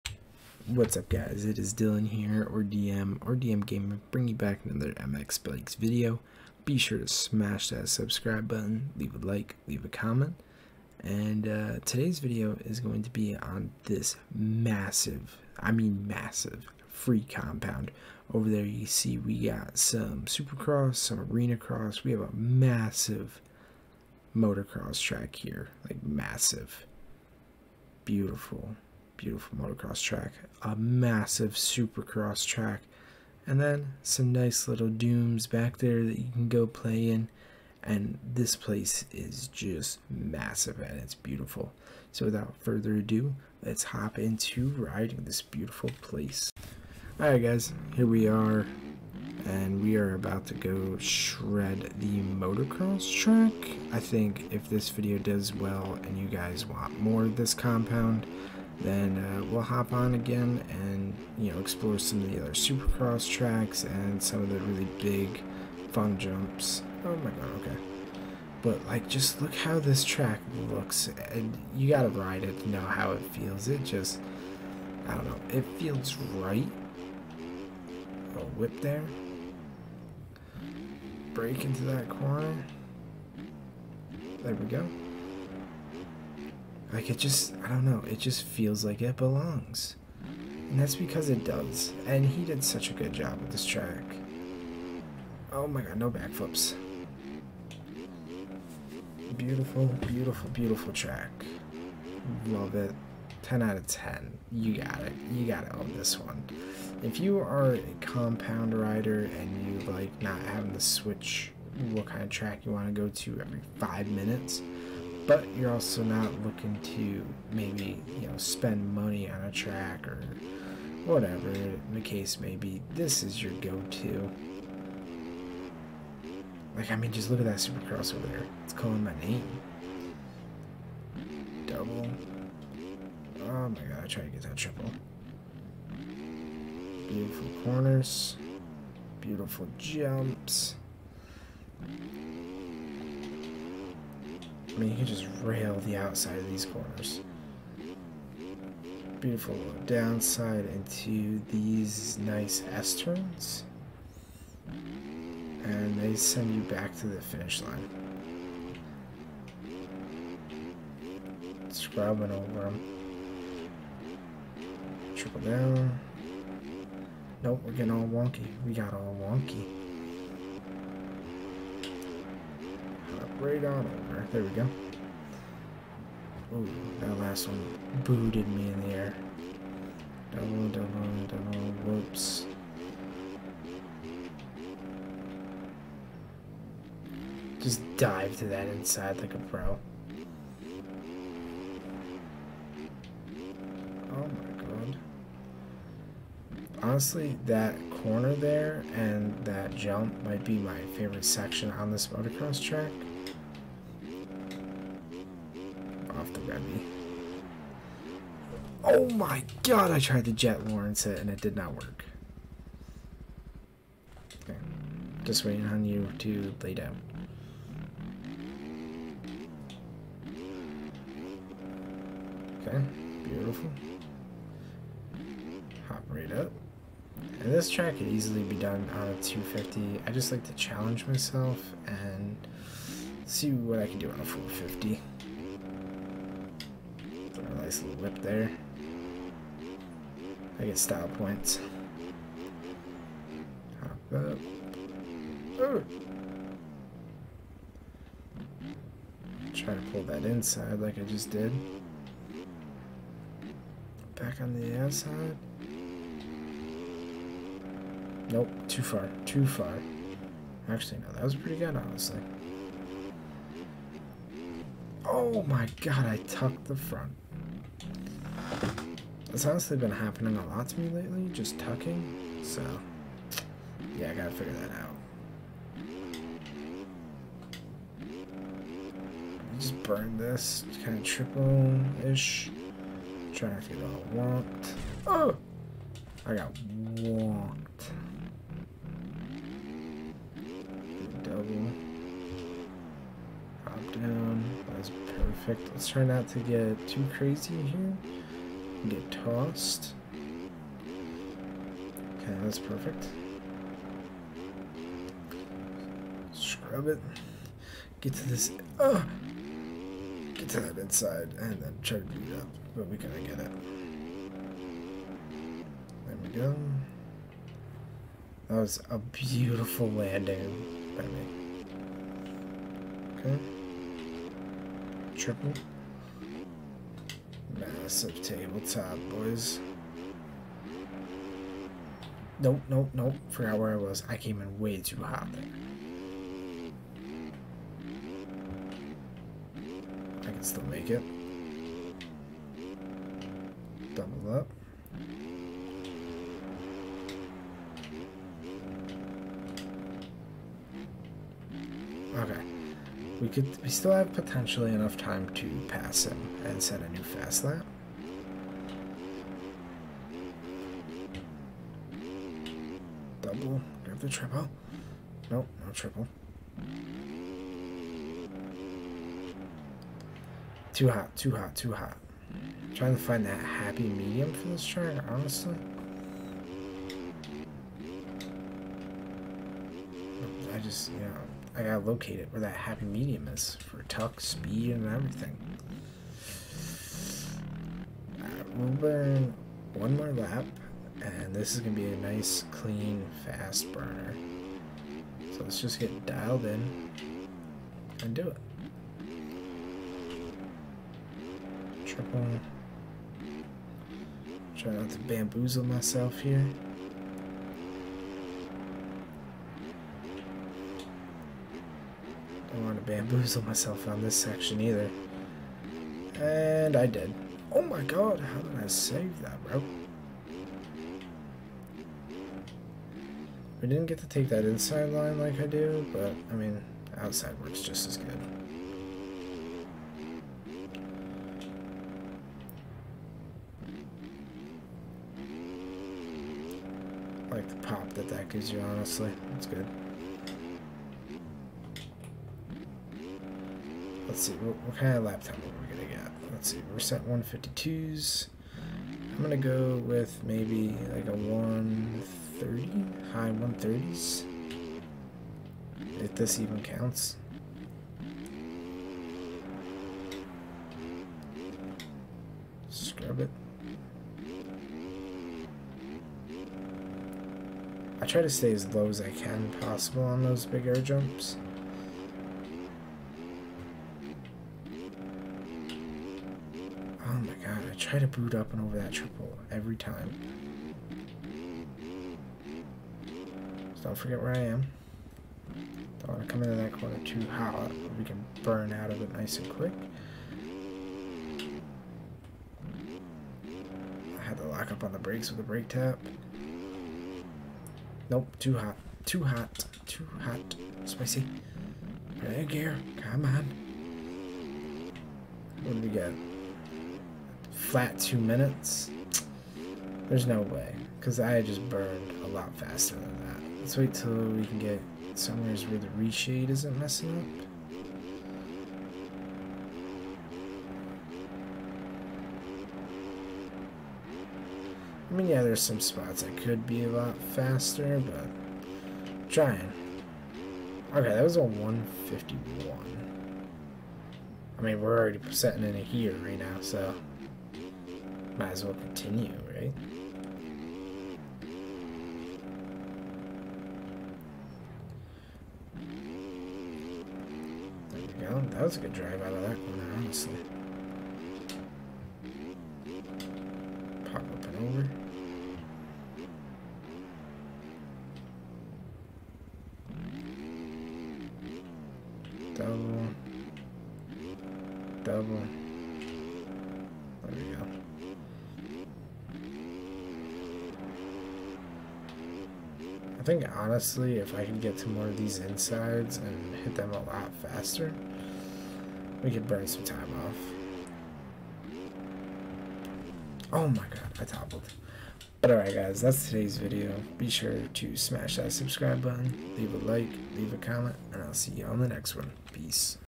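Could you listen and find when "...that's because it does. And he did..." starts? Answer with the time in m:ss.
1:30.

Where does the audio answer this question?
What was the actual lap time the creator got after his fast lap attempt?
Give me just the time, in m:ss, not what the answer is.
8:51.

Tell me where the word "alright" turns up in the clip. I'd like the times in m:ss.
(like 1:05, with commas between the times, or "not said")
0:47, 9:45.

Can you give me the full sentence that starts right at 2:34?
And they send you back to the finish line.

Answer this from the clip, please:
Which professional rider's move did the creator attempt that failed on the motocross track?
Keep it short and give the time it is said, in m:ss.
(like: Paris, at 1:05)
Jet Lawrence, at 3:30.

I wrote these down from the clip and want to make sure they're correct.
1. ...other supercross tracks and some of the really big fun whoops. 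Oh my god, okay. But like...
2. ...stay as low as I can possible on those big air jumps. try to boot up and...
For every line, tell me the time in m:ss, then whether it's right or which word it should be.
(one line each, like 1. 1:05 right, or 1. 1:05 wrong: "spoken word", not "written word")
1. 1:02 wrong: "jumps", not "whoops"
2. 7:48 right.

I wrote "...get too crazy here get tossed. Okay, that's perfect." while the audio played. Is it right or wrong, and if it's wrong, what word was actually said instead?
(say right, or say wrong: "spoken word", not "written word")
right.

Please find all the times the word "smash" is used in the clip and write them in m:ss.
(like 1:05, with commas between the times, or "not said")
0:07, 9:47.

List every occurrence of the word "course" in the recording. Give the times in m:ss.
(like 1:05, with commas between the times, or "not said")
not said.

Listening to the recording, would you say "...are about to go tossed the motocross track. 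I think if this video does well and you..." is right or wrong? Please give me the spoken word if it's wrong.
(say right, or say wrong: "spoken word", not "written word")
wrong: "shred", not "tossed".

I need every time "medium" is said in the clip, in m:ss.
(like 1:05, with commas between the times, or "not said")
6:13, 6:22.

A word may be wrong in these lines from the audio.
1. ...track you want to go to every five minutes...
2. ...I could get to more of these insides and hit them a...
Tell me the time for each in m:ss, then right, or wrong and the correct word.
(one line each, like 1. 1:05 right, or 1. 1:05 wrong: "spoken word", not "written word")
1. 1:52 right
2. 9:34 right.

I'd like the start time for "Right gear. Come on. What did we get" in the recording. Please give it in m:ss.
8:22.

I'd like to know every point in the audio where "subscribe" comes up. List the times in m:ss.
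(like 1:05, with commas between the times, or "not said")
0:07, 9:48.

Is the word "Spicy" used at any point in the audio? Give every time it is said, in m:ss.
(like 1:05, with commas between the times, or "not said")
8:20.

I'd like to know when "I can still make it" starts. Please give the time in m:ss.
5:40.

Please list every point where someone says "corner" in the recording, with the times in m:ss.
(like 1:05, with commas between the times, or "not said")
1:22, 2:17, 2:26, 3:18, 8:06, 9:09.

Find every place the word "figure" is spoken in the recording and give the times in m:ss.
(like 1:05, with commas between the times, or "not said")
4:34, 4:43.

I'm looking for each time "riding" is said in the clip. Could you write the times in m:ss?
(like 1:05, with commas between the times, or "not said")
0:44.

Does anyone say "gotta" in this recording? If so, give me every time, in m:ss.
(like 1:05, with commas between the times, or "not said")
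1:11, 4:34, 5:12, 6:21.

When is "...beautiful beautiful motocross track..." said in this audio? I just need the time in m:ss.
0:28.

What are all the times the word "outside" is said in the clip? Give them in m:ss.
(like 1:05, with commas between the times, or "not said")
2:25, 4:14, 7:06.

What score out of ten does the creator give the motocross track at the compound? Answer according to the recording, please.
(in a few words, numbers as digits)
10 out of 10.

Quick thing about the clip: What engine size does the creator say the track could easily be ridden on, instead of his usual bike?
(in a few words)
250.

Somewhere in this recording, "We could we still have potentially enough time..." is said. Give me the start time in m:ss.
5:53.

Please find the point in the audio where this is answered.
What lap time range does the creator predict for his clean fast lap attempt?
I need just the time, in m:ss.
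7:33.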